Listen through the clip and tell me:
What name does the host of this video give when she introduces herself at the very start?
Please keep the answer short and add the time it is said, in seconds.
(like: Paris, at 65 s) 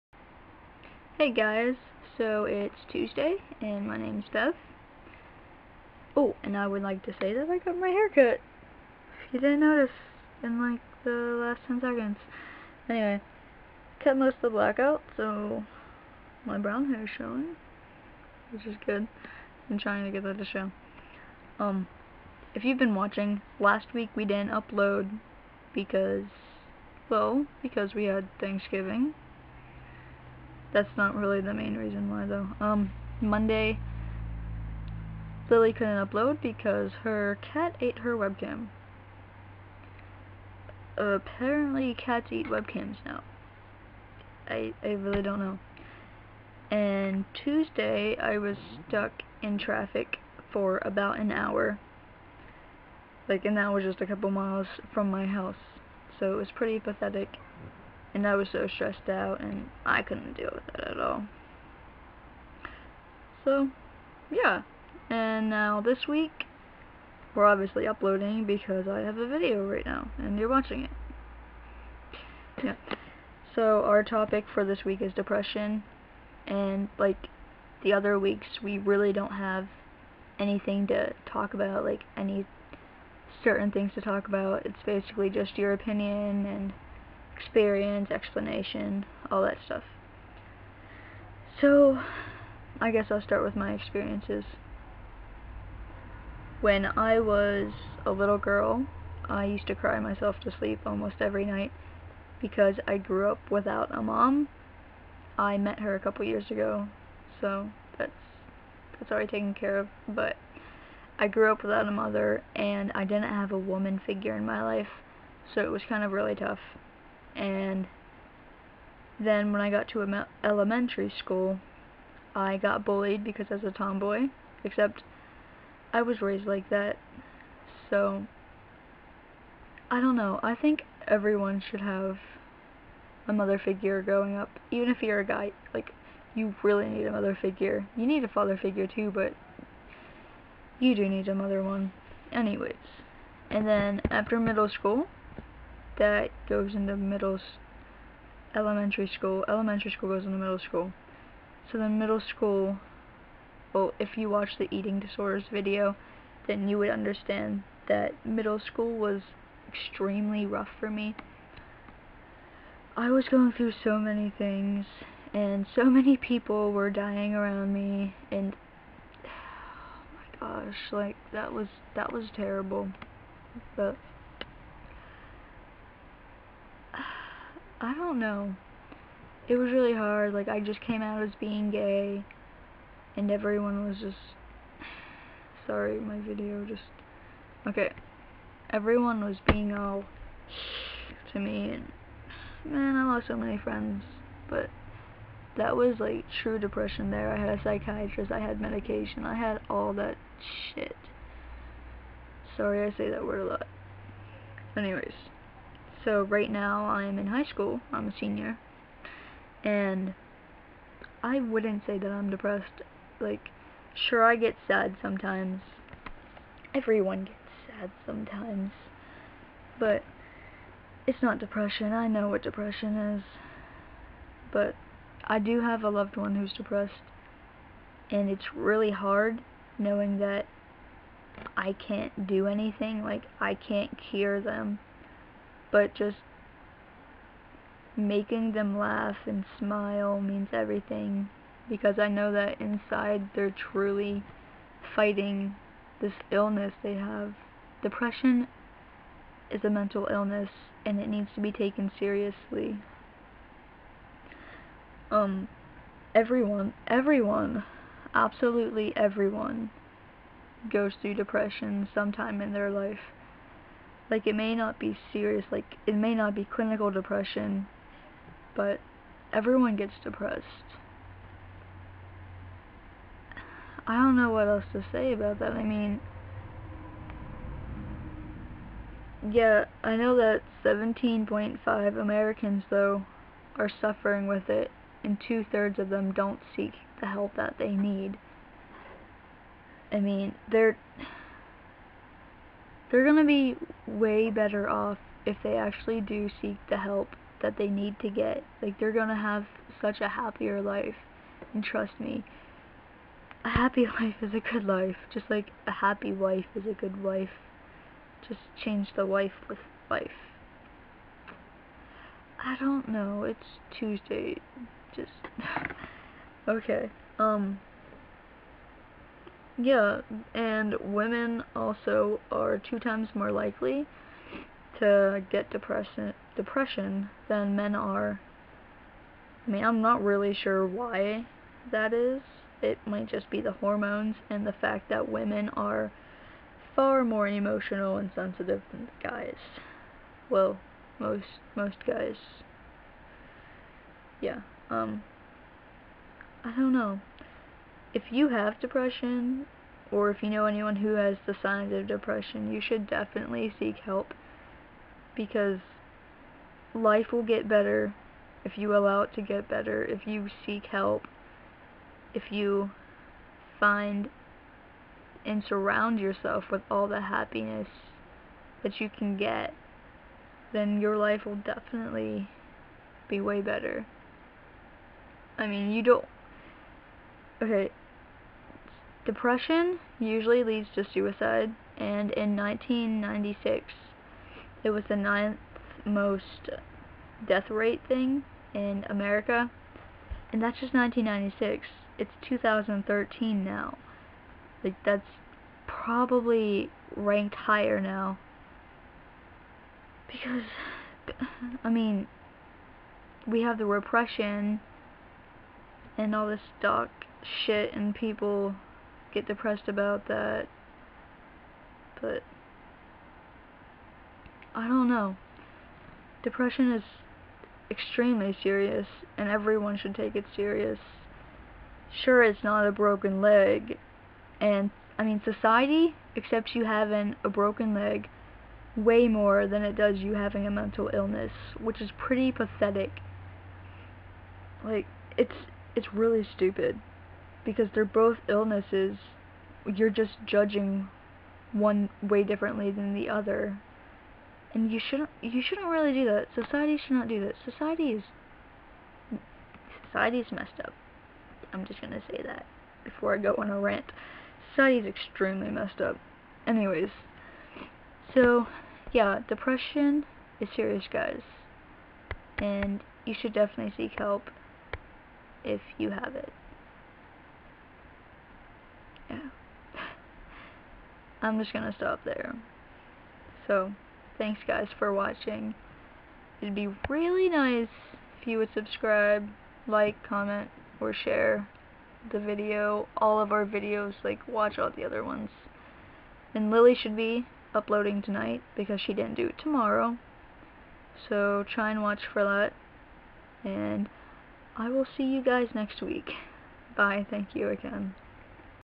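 Bev, at 4 s.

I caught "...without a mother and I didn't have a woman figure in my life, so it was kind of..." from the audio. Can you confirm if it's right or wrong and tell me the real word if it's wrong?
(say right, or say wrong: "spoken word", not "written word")
right.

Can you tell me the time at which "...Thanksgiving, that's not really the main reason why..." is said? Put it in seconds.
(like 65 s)
28 s.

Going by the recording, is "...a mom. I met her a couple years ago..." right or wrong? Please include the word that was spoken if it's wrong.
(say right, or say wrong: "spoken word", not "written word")
right.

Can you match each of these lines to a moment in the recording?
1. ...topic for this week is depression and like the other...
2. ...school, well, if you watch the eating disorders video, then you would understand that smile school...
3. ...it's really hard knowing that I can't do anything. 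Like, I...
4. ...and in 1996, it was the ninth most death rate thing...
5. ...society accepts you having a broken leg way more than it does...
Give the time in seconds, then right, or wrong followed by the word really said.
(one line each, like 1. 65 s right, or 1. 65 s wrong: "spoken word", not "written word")
1. 74 s right
2. 152 s wrong: "middle", not "smile"
3. 228 s right
4. 381 s right
5. 425 s right.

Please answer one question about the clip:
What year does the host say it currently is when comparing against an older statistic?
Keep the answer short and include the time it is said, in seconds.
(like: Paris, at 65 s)
2013, at 392 s.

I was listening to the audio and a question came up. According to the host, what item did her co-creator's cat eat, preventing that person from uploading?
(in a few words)
webcam.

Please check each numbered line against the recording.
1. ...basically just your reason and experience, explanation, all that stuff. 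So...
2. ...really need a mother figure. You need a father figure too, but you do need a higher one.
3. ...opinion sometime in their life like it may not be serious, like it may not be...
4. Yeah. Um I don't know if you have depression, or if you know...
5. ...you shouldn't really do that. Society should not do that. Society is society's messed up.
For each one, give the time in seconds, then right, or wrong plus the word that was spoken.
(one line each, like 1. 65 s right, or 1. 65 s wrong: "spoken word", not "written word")
1. 84 s wrong: "opinion", not "reason"
2. 136 s wrong: "mother", not "higher"
3. 261 s wrong: "depression", not "opinion"
4. 344 s right
5. 445 s right.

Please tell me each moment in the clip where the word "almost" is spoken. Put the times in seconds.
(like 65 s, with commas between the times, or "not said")
100 s.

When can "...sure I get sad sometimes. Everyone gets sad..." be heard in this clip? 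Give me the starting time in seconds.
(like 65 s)
213 s.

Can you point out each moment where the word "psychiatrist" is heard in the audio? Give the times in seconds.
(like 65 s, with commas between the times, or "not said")
197 s.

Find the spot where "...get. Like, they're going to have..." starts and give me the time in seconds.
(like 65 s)
298 s.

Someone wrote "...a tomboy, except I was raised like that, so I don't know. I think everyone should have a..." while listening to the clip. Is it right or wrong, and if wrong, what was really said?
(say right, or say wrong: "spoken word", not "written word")
right.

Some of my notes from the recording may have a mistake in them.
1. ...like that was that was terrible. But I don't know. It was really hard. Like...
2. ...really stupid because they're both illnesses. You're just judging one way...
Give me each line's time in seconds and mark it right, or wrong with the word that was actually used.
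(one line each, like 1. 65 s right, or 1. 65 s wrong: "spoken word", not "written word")
1. 170 s right
2. 435 s right.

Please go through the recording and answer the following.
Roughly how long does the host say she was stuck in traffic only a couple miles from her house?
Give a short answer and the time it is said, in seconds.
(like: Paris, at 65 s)
about an hour, at 50 s.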